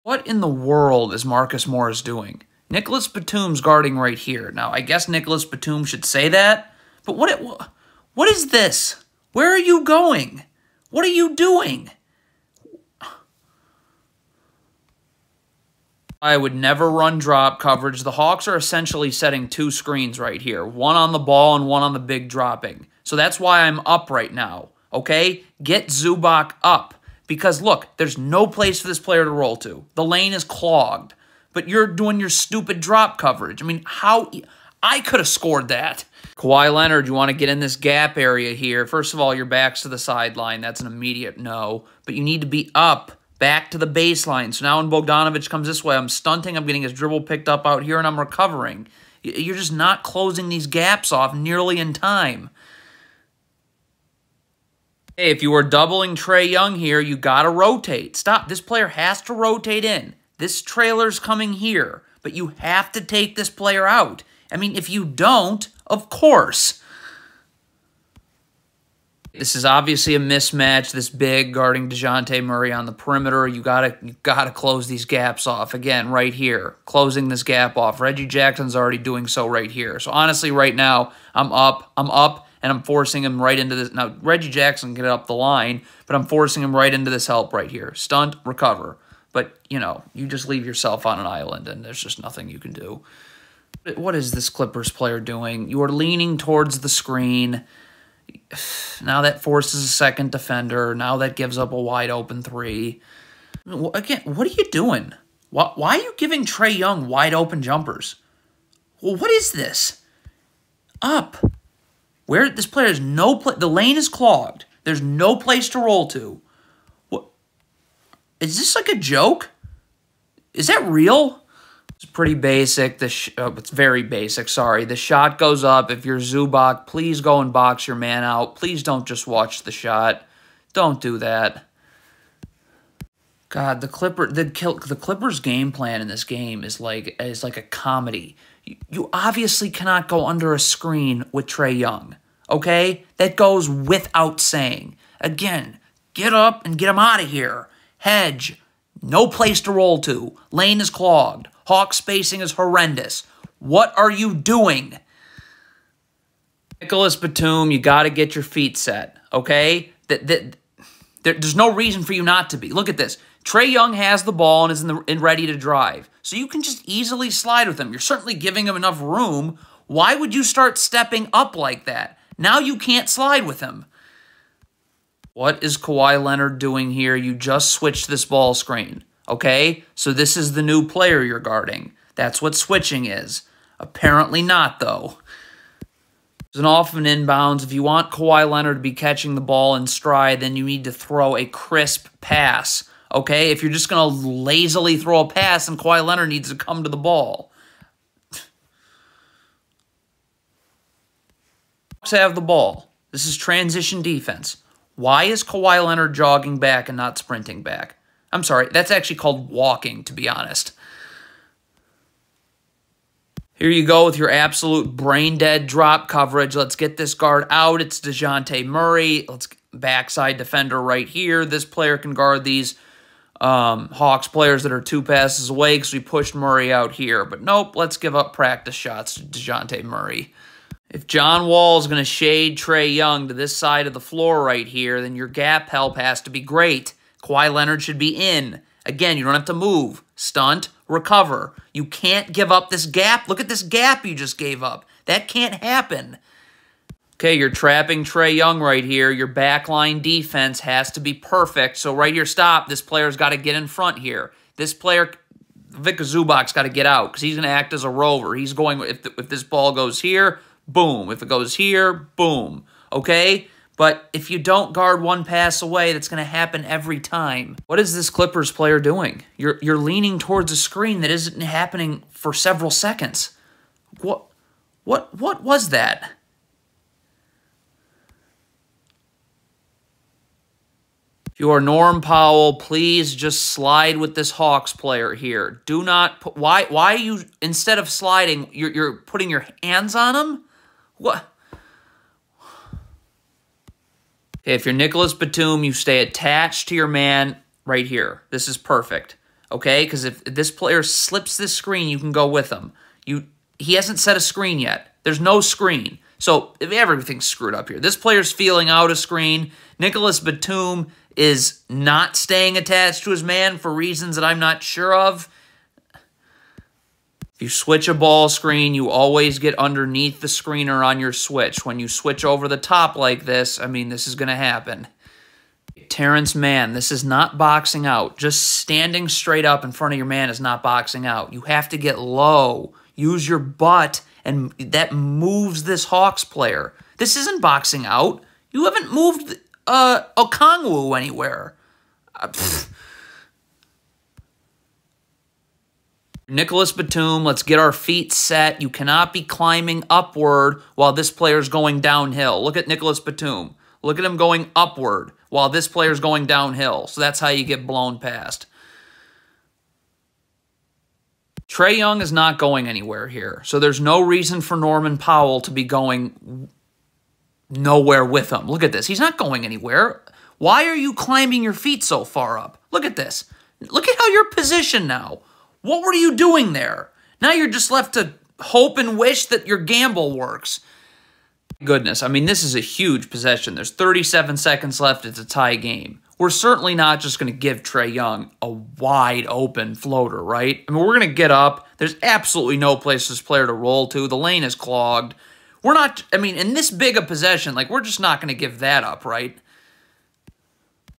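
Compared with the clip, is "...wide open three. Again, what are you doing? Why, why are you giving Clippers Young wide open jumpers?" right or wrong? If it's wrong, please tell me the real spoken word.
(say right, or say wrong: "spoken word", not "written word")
wrong: "Trae", not "Clippers".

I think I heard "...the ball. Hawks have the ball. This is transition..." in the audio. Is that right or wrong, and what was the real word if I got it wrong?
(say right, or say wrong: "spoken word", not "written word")
right.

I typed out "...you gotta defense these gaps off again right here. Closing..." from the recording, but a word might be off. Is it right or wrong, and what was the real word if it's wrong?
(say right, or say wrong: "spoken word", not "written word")
wrong: "close", not "defense".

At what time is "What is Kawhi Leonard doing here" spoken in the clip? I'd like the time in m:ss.
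2:55.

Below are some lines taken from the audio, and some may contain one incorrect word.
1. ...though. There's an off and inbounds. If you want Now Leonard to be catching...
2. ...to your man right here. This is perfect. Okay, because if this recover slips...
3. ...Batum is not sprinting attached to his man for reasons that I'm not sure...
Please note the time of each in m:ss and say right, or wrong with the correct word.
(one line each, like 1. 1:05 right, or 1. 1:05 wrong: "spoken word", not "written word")
1. 3:04 wrong: "Kawhi", not "Now"
2. 4:56 wrong: "player", not "recover"
3. 5:10 wrong: "staying", not "sprinting".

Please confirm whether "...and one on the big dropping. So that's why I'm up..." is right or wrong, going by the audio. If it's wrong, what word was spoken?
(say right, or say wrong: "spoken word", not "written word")
right.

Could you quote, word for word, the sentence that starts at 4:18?
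He's going, if, the, if this ball goes here, boom.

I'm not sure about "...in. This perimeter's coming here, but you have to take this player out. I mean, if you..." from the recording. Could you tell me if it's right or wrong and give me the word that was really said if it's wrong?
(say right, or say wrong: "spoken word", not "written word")
wrong: "trailer", not "perimeter".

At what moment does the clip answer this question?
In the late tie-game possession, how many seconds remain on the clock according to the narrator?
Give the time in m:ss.
6:23.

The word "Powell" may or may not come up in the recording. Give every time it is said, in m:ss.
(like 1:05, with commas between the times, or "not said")
4:42, 6:04.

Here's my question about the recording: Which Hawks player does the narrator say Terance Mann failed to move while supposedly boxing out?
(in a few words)
Kongwu.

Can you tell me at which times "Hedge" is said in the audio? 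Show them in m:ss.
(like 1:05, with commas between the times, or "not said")
2:27.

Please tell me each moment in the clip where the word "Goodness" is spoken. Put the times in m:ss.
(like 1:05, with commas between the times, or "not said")
6:21.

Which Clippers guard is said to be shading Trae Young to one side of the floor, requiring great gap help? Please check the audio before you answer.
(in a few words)
John Wall.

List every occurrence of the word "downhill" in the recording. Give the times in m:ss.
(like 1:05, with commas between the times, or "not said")
5:51, 5:56.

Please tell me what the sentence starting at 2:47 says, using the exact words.
You're certainly giving him enough room.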